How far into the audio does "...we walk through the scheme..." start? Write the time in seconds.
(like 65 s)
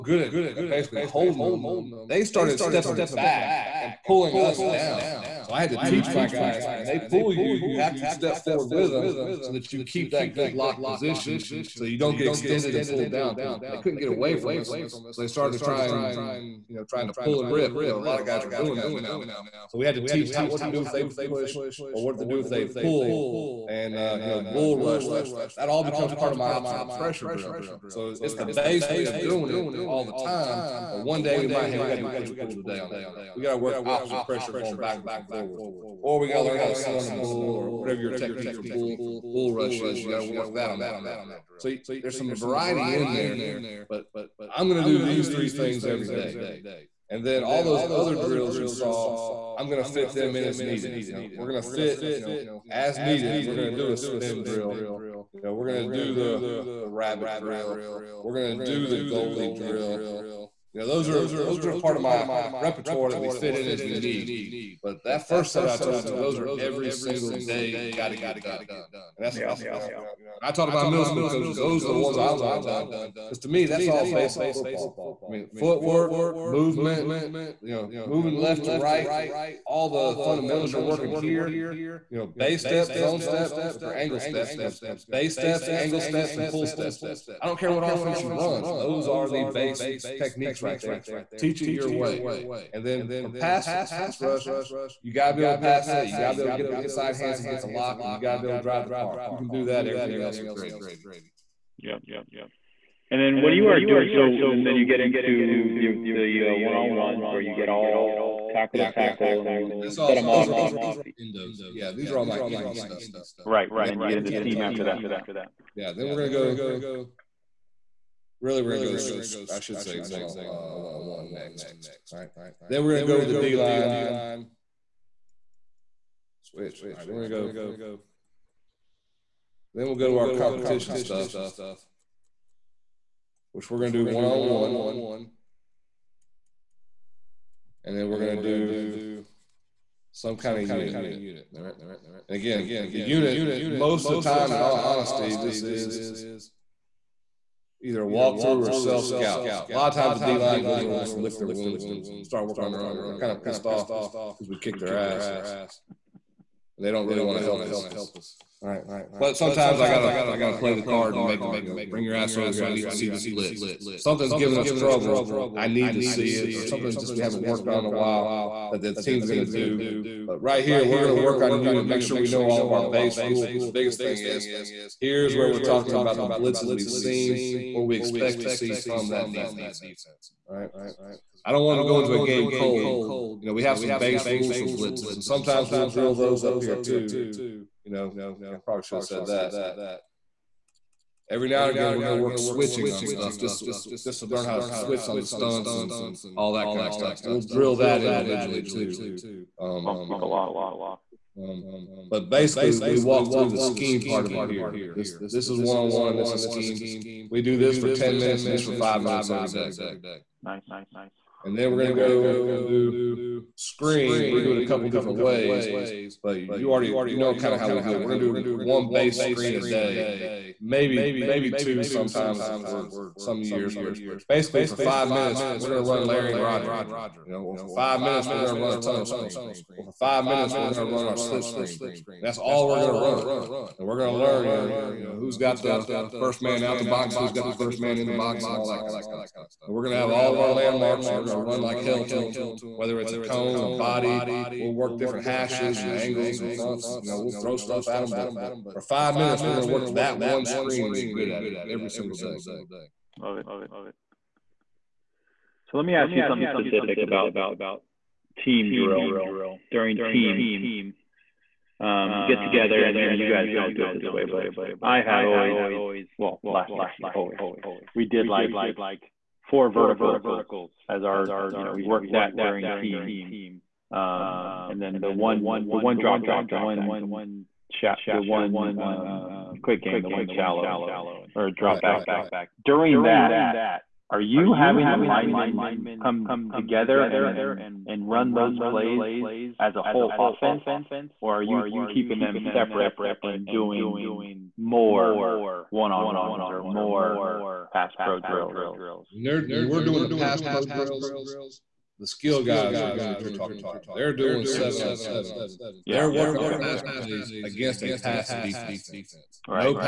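202 s.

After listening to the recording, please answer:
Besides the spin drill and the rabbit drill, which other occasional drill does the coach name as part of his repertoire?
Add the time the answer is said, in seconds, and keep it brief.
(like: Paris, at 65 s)
goalie drill, at 58 s.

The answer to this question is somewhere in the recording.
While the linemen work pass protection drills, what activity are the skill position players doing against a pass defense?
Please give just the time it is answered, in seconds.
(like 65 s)
304 s.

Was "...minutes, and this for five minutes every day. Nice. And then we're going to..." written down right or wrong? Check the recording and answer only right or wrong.
right.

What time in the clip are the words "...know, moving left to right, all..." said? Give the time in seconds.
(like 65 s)
77 s.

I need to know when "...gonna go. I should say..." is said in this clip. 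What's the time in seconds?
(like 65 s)
118 s.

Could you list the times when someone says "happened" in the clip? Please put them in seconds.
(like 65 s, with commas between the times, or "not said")
not said.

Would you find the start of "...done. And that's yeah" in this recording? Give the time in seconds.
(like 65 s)
68 s.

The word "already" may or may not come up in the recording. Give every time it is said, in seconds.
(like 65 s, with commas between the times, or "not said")
216 s.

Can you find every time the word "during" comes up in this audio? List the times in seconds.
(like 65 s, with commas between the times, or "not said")
259 s, 272 s, 282 s.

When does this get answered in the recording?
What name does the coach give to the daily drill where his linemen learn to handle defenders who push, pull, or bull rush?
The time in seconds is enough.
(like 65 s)
26 s.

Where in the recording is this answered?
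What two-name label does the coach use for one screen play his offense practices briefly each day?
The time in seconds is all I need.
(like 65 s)
226 s.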